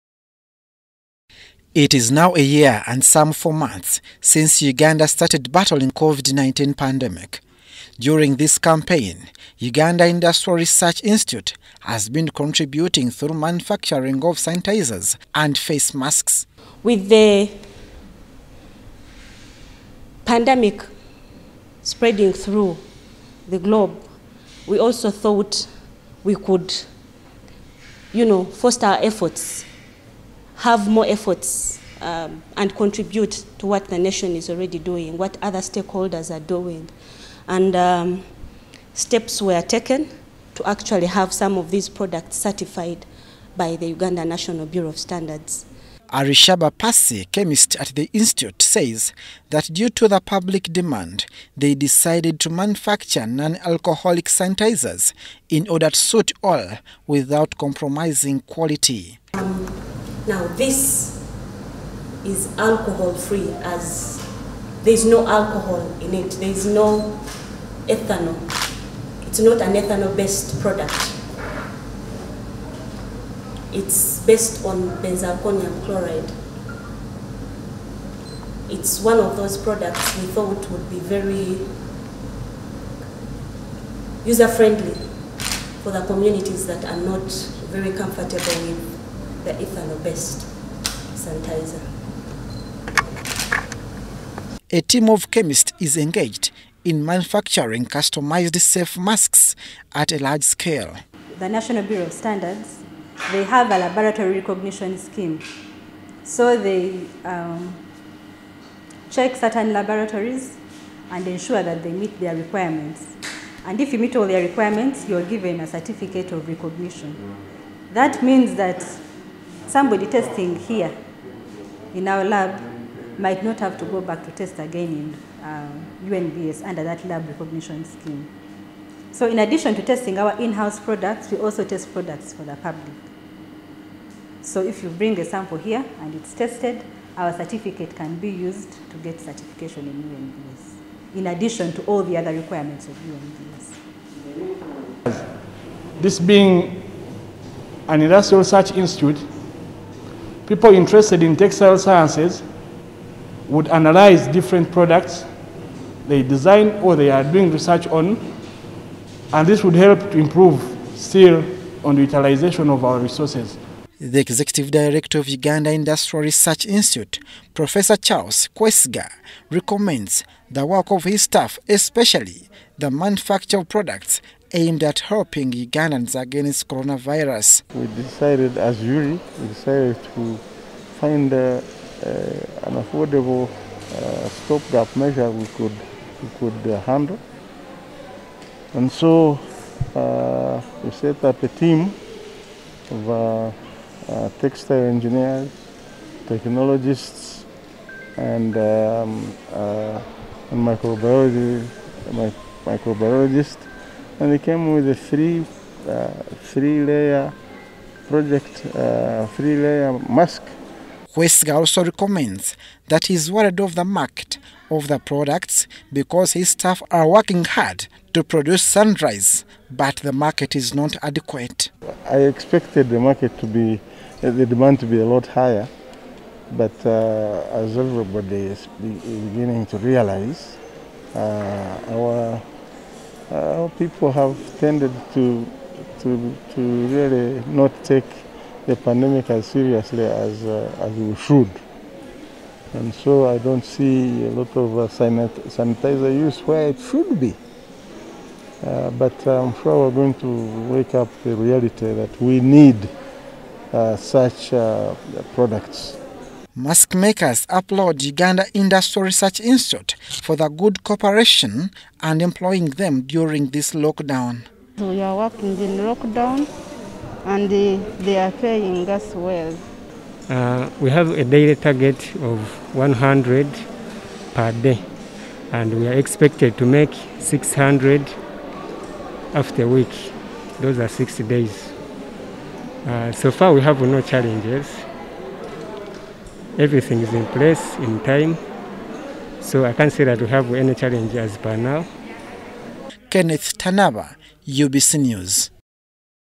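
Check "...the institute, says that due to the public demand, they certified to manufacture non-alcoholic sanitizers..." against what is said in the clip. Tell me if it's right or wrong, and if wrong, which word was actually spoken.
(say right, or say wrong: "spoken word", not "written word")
wrong: "decided", not "certified".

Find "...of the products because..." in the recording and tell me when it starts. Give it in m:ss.
3:34.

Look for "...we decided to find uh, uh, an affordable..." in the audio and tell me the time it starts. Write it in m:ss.
2:59.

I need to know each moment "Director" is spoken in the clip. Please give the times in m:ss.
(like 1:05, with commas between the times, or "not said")
2:44.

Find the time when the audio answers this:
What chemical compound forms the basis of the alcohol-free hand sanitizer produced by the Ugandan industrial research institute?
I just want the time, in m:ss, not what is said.
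1:15.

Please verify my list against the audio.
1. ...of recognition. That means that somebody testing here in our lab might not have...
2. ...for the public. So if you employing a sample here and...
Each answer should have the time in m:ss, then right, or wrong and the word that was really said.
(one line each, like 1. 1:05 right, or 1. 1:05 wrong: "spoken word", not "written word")
1. 1:56 right
2. 2:12 wrong: "bring", not "employing".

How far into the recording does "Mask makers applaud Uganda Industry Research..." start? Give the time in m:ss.
4:16.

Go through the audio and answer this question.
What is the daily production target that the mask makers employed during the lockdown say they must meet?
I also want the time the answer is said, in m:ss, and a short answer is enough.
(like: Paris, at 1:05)
100, at 4:32.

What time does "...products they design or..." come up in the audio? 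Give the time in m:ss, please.
2:34.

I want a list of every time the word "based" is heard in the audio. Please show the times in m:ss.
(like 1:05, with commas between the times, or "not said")
1:10, 1:14, 1:29.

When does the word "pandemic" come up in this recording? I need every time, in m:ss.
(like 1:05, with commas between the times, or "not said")
0:06, 0:20, 3:58.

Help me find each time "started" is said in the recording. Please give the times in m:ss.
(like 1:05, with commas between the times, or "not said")
0:05.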